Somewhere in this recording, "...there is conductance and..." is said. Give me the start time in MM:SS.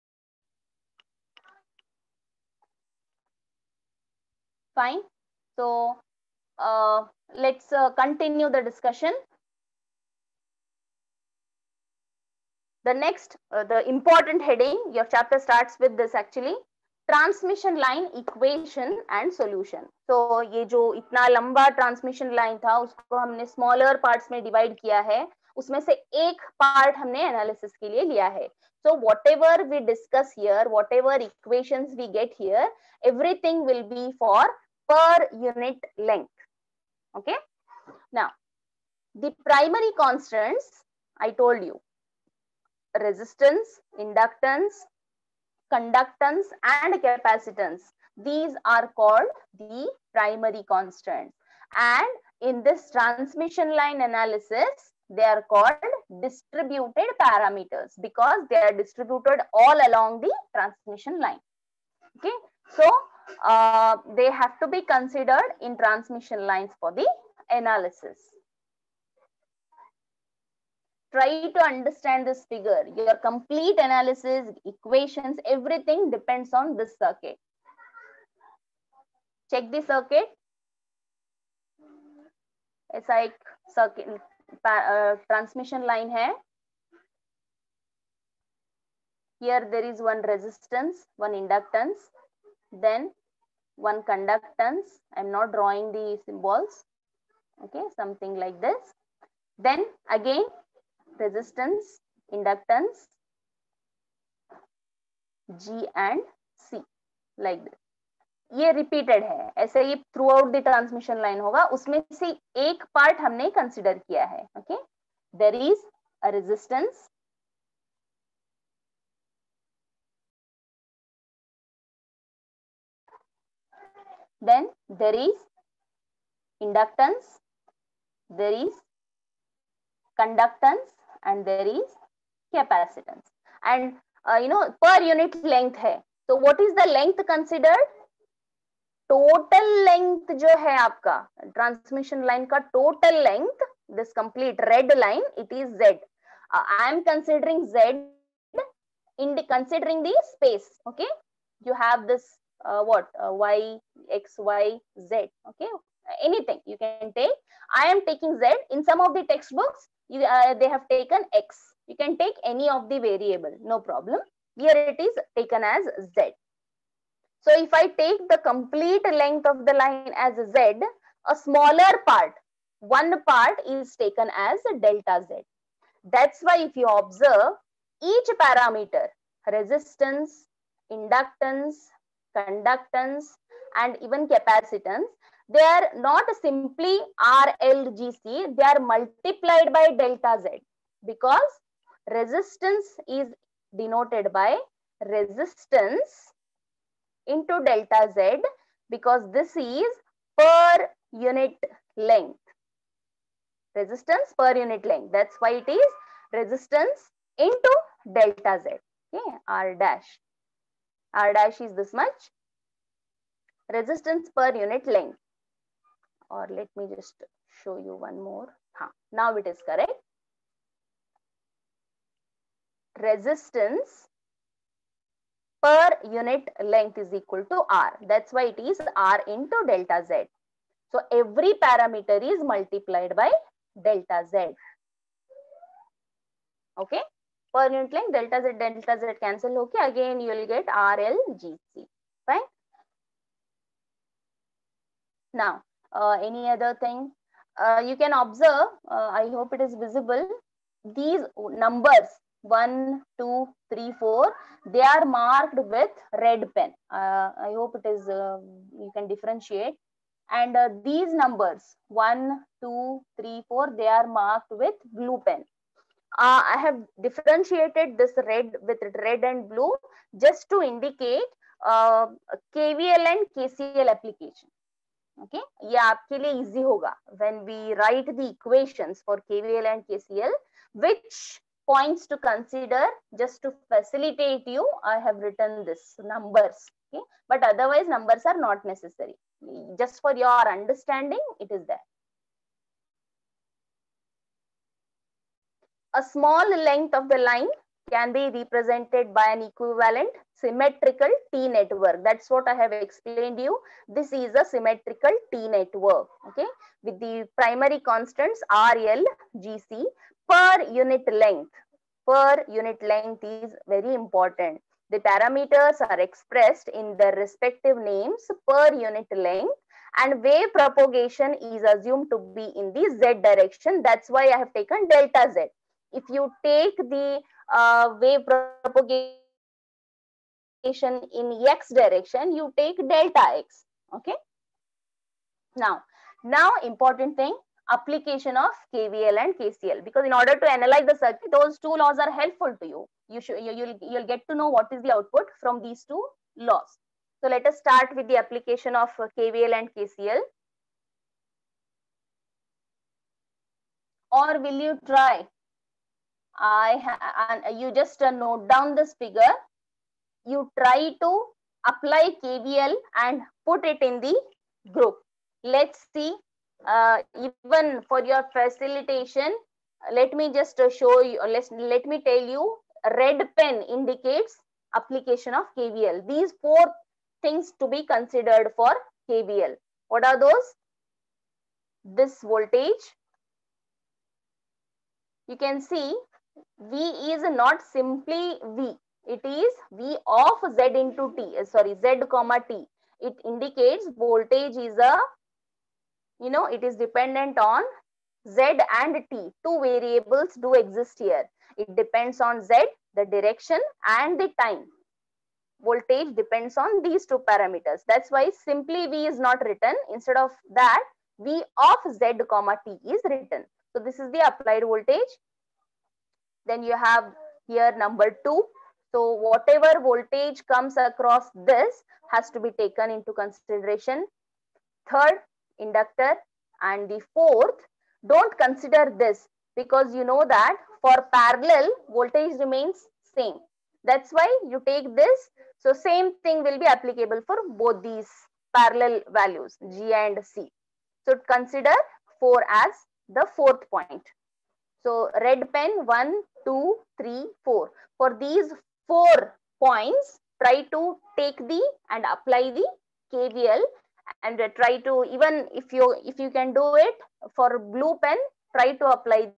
02:08.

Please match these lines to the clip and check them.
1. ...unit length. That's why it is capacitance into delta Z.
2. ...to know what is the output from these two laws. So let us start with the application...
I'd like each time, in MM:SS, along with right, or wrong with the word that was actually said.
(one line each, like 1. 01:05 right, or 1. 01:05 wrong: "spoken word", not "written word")
1. 03:24 wrong: "resistance", not "capacitance"
2. 05:44 right.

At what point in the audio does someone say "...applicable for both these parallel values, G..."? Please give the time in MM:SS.
07:16.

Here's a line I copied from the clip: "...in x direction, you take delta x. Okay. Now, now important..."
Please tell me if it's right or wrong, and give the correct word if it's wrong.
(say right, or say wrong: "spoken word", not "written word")
right.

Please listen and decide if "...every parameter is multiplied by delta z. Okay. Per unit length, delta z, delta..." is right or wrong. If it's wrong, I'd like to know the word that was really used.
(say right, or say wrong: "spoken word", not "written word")
right.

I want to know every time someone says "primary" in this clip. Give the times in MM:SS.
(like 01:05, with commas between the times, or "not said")
00:39, 00:50, 05:07.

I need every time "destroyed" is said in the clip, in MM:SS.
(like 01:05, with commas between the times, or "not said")
not said.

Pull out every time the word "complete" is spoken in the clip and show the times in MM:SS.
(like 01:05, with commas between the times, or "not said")
01:13, 02:48.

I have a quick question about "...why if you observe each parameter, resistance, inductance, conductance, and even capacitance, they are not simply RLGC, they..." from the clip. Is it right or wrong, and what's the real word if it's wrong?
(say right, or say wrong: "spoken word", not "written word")
right.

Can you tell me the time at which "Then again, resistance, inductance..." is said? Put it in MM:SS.
01:39.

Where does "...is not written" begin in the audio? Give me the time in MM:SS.
06:49.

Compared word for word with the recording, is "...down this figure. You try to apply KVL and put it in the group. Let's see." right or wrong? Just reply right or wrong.
right.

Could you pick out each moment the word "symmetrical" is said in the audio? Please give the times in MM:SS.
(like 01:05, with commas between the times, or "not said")
05:00, 05:04.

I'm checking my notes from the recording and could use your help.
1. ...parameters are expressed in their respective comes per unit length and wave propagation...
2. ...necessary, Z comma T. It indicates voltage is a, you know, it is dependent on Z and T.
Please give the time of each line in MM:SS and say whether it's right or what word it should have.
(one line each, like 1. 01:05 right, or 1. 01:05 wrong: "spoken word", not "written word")
1. 05:14 wrong: "names", not "comes"
2. 06:31 wrong: "sorry", not "necessary".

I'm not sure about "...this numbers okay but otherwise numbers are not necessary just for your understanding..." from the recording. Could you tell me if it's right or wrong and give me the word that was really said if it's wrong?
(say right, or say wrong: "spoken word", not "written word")
right.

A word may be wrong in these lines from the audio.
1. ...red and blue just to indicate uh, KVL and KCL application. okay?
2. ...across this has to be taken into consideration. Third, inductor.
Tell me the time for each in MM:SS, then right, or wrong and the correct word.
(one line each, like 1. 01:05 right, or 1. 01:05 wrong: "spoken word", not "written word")
1. 04:29 right
2. 07:00 right.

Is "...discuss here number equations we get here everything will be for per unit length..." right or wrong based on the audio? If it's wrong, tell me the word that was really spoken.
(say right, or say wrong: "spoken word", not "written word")
wrong: "whatever", not "number".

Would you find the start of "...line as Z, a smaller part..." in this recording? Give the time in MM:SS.
02:49.